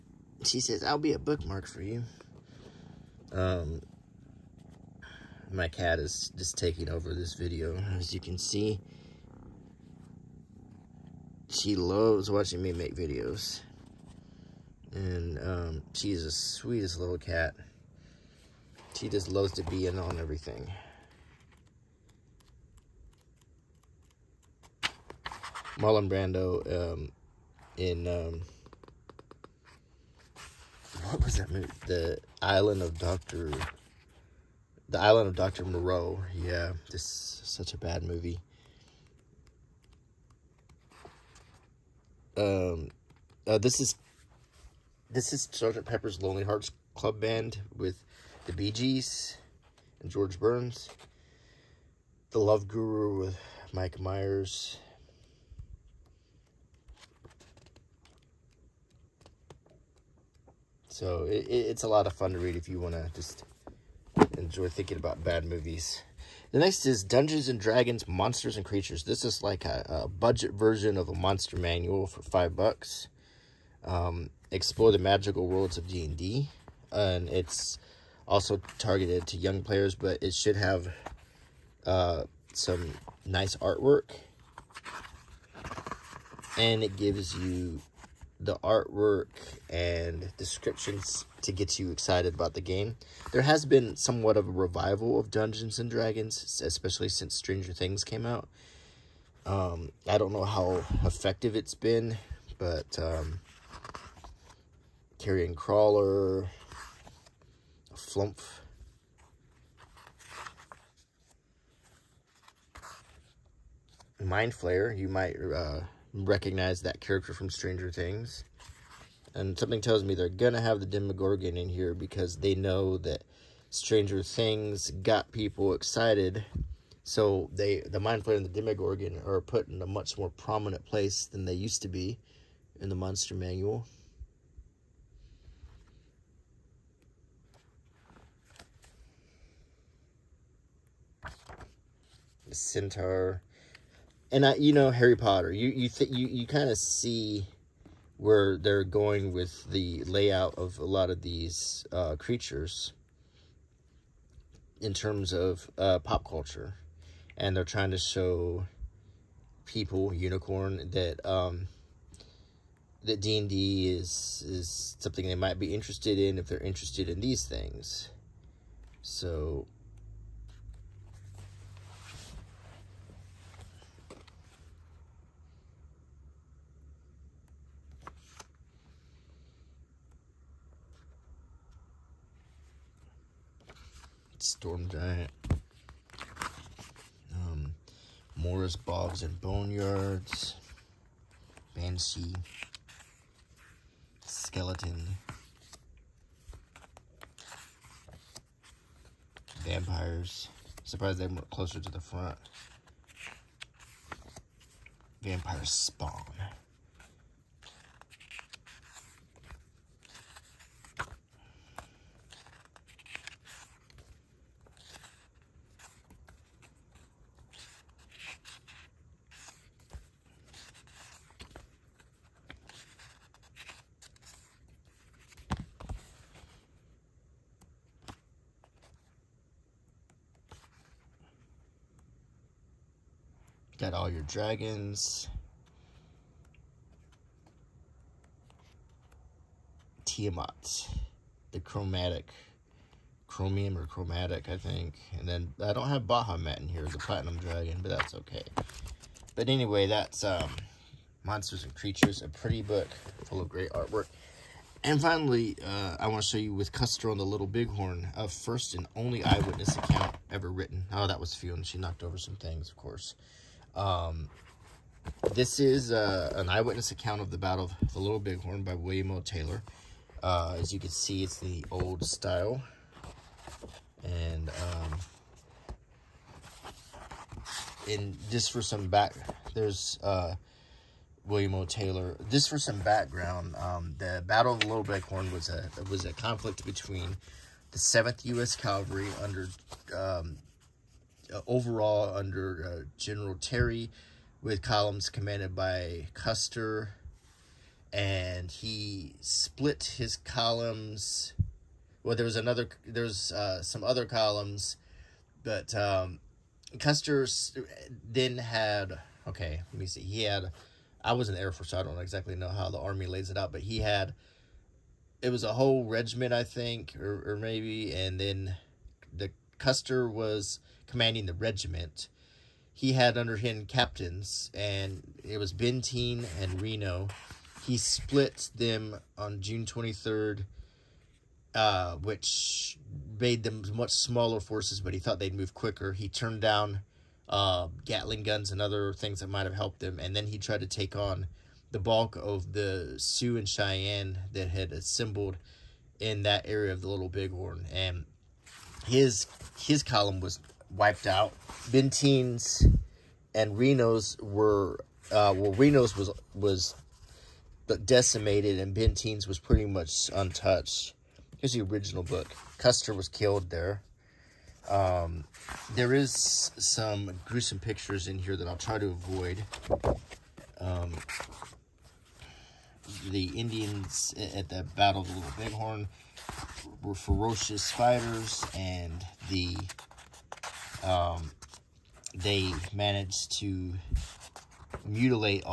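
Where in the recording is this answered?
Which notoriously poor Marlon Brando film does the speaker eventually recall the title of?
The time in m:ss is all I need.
0:34.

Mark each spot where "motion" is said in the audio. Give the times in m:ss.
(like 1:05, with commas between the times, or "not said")
not said.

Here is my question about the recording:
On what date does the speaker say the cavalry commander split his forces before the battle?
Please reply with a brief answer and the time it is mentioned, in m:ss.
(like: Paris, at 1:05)
June 23, at 5:29.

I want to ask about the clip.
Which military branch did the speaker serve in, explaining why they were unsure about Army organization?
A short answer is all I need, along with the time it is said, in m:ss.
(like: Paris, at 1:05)
Air Force, at 5:11.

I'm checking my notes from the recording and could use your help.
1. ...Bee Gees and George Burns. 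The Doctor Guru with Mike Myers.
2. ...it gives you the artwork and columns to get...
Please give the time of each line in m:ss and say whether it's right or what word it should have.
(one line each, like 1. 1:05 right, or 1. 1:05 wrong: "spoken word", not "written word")
1. 0:48 wrong: "Love", not "Doctor"
2. 1:26 wrong: "descriptions", not "columns".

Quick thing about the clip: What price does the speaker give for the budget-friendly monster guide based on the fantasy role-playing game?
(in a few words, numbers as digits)
$5.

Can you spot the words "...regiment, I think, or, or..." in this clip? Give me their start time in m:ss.
5:15.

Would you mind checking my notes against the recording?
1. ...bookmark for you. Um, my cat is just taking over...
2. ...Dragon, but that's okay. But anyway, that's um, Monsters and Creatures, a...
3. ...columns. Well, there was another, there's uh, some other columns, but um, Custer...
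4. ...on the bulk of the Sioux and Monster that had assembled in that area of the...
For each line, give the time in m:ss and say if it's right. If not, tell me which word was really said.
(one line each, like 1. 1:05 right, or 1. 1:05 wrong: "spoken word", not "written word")
1. 0:01 right
2. 4:07 right
3. 5:00 right
4. 5:40 wrong: "Cheyenne", not "Monster".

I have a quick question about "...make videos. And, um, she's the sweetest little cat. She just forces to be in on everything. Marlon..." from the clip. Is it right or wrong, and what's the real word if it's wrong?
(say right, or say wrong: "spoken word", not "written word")
wrong: "loves", not "forces".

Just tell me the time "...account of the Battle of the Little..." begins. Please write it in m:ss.
4:26.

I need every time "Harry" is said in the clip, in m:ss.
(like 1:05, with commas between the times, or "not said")
2:24.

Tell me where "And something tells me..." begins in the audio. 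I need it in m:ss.
1:59.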